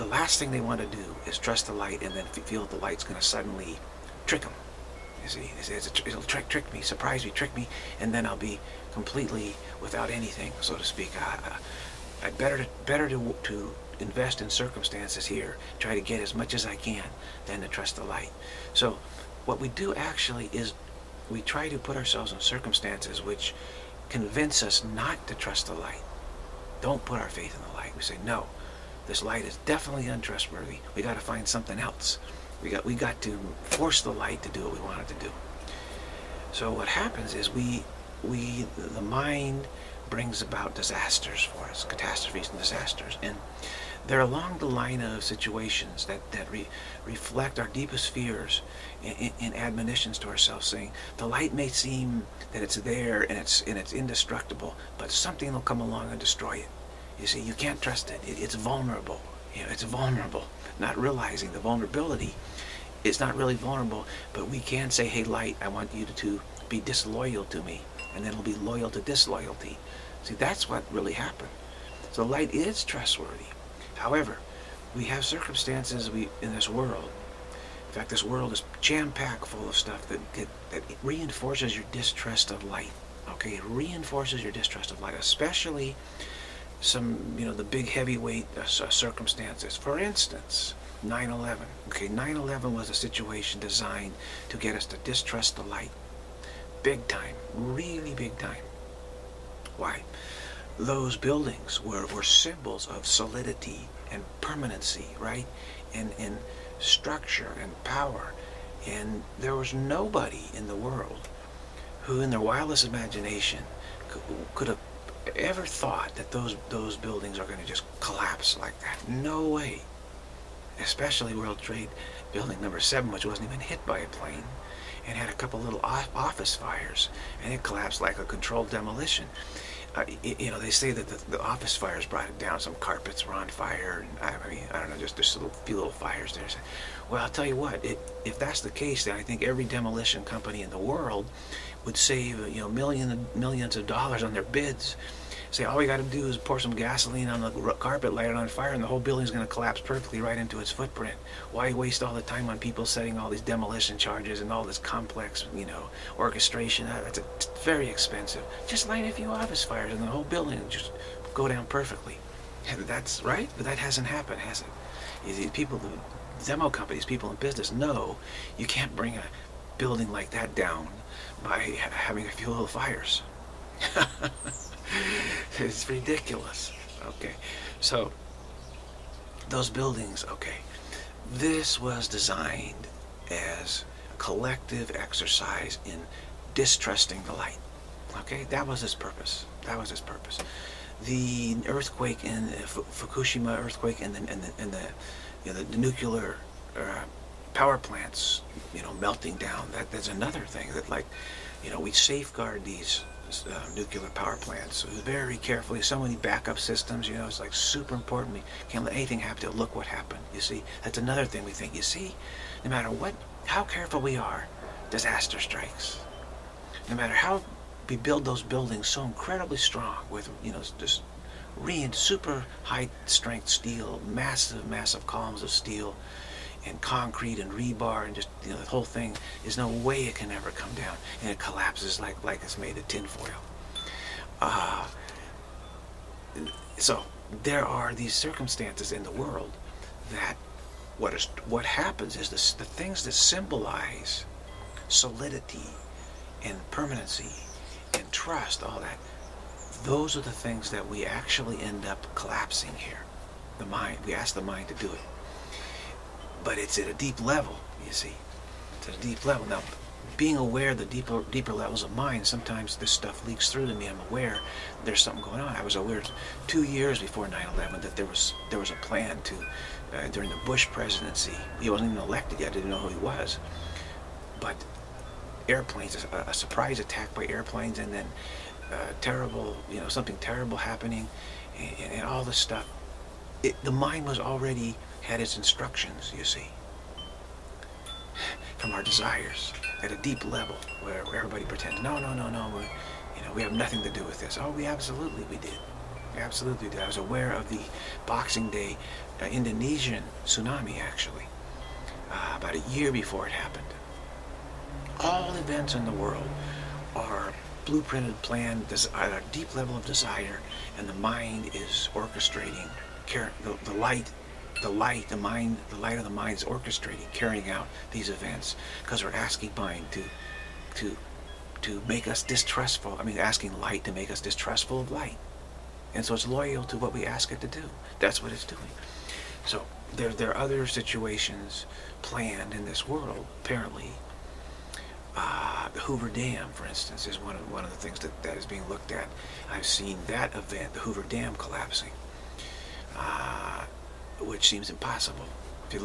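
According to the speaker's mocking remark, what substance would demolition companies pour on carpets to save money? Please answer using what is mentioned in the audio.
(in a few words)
gasoline.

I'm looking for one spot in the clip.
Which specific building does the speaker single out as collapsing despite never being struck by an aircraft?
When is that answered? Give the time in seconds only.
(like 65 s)
121 s.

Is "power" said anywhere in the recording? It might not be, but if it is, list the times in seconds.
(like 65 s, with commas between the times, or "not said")
107 s, 197 s, 204 s.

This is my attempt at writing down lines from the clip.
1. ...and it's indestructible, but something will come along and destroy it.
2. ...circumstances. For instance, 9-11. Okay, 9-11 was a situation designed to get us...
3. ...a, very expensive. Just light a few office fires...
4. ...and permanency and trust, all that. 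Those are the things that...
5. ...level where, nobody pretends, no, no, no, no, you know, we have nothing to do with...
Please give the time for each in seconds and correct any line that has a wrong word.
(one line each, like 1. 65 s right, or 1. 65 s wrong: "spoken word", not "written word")
1. 53 s right
2. 88 s right
3. 157 s right
4. 246 s right
5. 290 s wrong: "everybody", not "nobody".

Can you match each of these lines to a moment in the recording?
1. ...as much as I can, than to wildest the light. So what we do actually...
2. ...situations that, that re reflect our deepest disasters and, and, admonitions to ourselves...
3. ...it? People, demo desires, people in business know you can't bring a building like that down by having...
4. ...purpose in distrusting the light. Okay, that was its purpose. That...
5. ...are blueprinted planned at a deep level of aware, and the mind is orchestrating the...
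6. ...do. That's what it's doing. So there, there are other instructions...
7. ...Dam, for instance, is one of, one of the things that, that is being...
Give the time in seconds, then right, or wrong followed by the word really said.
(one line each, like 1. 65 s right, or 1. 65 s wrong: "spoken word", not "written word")
1. 16 s wrong: "trust", not "wildest"
2. 45 s wrong: "fears", not "disasters"
3. 165 s wrong: "companies", not "desires"
4. 184 s wrong: "exercise", not "purpose"
5. 306 s wrong: "desire", not "aware"
6. 327 s wrong: "situations", not "instructions"
7. 336 s right.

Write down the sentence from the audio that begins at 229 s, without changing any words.
There's no way it can ever come down, and it collapses like like it's made of tinfoil.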